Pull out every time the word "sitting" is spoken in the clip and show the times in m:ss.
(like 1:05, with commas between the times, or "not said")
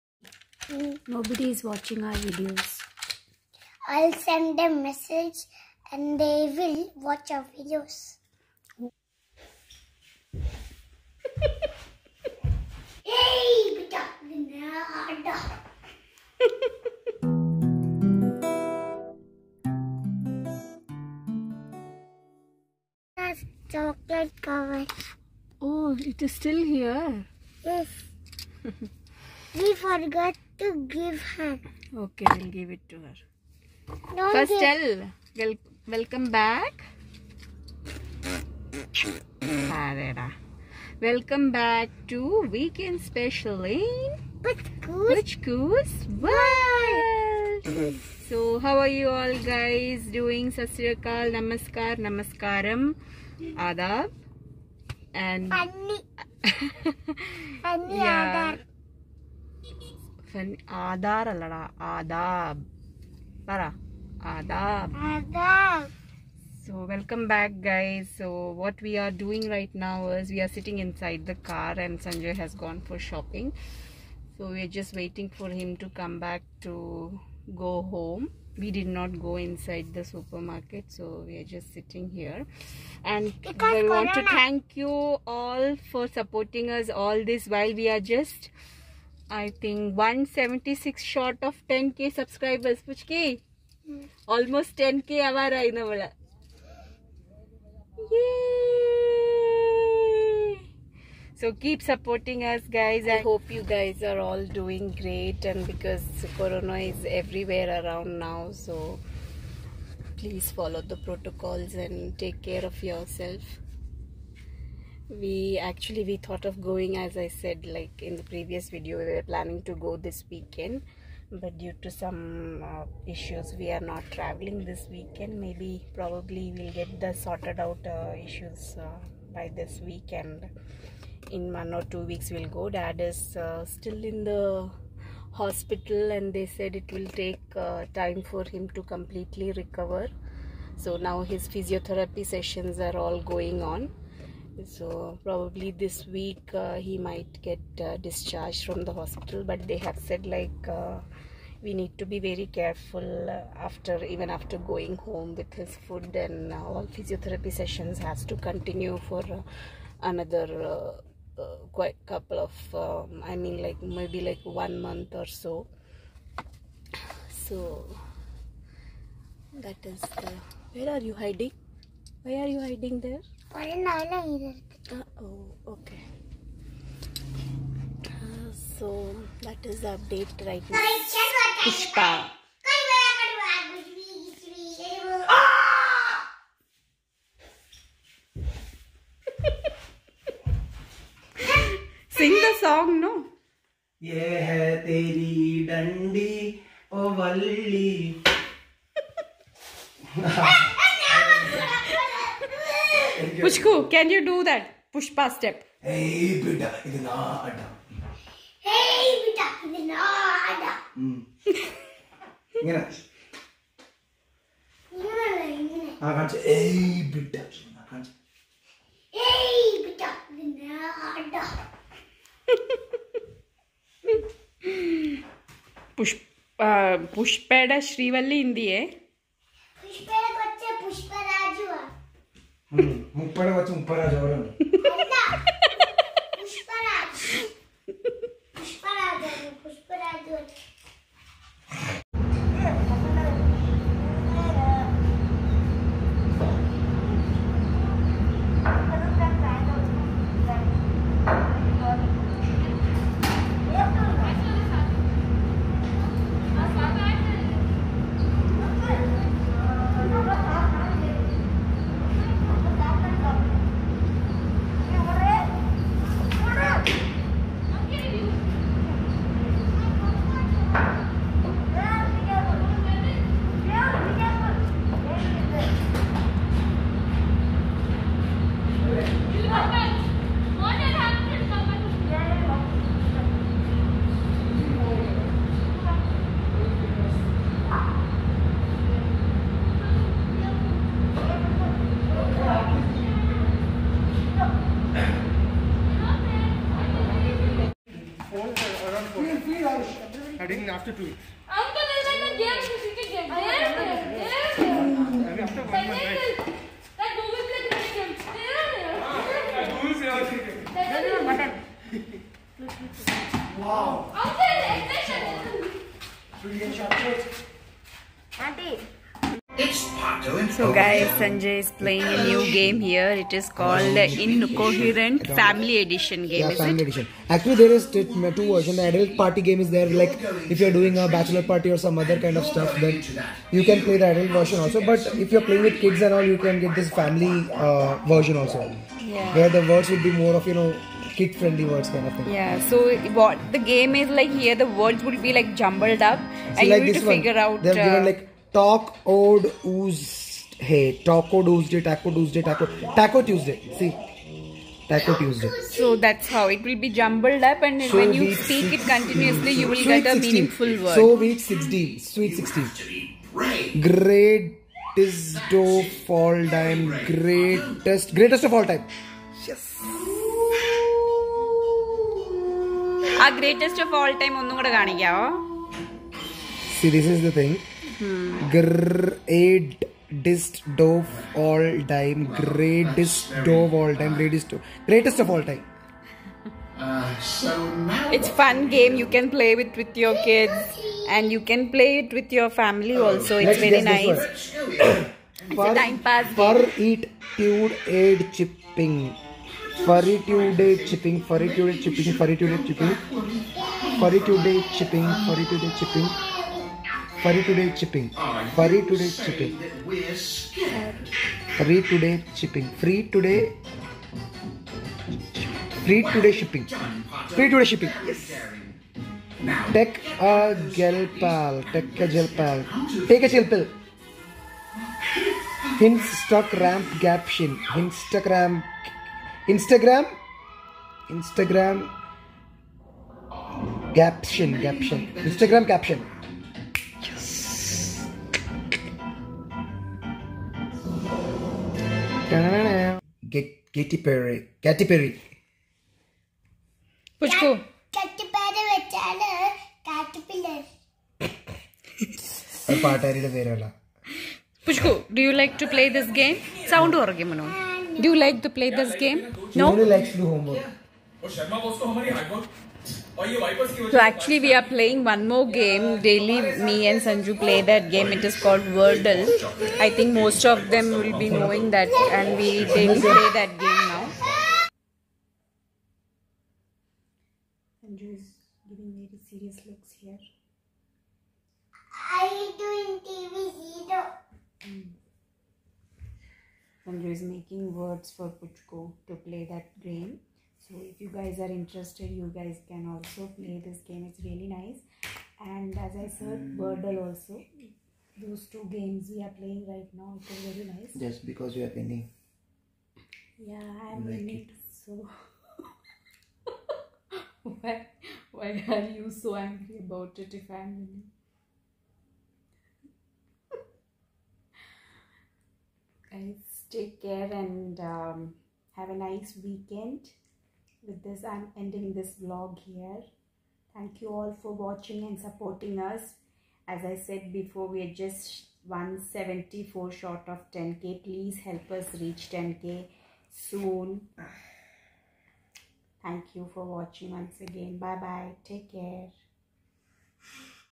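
1:10, 1:21.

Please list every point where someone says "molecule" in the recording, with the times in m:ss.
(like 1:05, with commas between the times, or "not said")
not said.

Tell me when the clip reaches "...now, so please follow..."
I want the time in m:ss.
1:48.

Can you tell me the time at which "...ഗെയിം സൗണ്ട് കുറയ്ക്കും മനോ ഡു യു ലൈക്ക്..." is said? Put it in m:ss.
7:36.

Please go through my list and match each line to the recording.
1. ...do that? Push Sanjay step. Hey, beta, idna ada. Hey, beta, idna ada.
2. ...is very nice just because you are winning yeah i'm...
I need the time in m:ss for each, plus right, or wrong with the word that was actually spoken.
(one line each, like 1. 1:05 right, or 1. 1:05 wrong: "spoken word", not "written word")
1. 3:24 wrong: "Pushpa", not "Sanjay"
2. 8:20 right.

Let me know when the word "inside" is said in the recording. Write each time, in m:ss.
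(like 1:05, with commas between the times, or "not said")
1:10, 1:19.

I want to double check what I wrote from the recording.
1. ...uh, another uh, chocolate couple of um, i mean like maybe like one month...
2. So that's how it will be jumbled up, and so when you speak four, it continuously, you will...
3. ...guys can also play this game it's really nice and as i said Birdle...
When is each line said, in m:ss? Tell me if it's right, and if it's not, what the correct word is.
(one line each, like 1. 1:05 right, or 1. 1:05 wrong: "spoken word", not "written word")
1. 2:39 wrong: "quite", not "chocolate"
2. 5:55 wrong: "six", not "four"
3. 8:12 right.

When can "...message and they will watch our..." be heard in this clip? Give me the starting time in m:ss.
0:04.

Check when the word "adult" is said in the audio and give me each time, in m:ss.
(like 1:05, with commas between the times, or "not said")
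5:28, 5:34.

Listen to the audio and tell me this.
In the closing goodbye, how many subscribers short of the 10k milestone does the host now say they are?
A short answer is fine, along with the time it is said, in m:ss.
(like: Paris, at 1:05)
174, at 8:48.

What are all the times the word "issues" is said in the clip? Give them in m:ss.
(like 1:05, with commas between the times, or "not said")
2:03, 2:08.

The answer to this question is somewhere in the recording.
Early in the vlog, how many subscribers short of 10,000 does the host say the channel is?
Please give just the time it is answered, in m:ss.
1:29.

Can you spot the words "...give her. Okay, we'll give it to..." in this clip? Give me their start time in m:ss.
0:30.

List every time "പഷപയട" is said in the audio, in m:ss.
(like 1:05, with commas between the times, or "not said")
3:47.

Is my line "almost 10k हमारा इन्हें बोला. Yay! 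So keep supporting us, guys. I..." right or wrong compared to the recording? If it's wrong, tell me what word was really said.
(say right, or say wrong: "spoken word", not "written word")
right.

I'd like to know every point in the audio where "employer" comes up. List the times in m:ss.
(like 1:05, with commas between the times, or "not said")
not said.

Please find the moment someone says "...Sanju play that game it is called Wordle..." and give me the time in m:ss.
7:47.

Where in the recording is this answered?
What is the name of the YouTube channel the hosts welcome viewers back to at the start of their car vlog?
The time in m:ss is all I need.
0:44.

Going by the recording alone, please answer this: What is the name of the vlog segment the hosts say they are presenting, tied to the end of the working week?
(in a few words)
Weekend Special.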